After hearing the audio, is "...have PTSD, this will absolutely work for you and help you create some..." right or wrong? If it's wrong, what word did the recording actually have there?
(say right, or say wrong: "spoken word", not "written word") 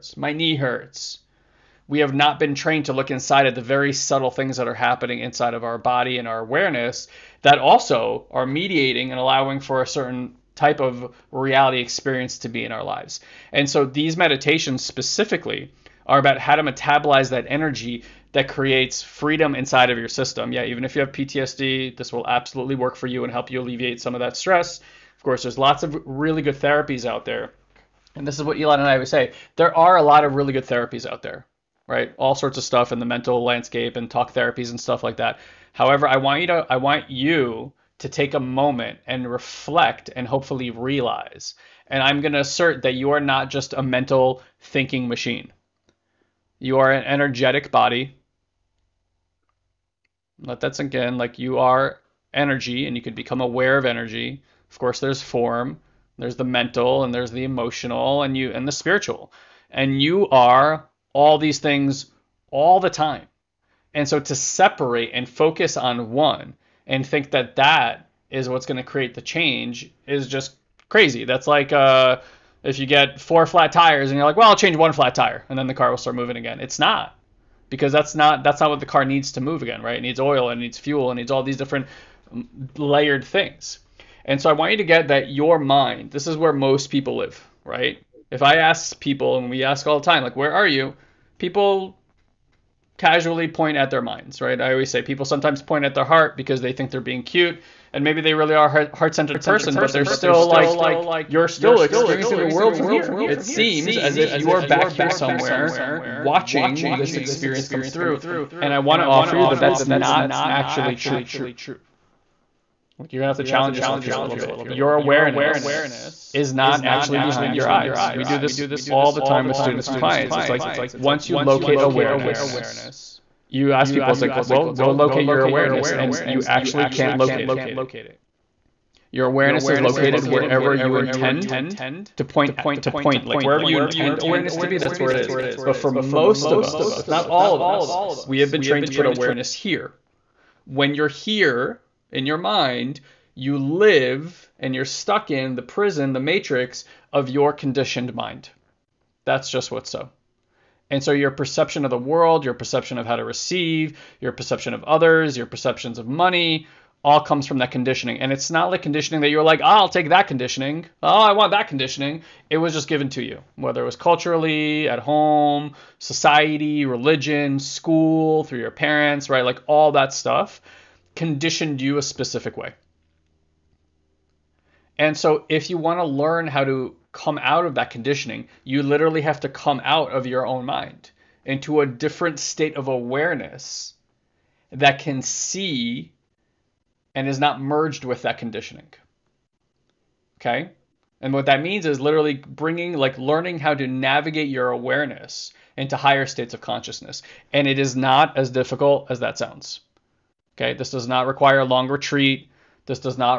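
wrong: "alleviate", not "create".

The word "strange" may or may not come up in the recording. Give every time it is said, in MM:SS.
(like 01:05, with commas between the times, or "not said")
not said.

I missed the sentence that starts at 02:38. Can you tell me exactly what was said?
And it's not like conditioning that you're like, oh, I'll take that conditioning.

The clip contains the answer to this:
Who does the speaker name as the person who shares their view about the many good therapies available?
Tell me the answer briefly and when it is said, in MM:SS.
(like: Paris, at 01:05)
Ilan, at 00:28.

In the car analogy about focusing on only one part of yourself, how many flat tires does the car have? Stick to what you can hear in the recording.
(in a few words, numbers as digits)
4.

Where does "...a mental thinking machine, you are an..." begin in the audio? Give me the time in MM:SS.
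00:43.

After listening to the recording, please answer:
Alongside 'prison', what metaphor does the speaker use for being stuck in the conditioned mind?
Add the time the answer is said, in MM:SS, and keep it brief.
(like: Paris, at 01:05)
the matrix, at 02:26.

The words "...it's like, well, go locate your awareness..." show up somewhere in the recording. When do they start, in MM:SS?
02:04.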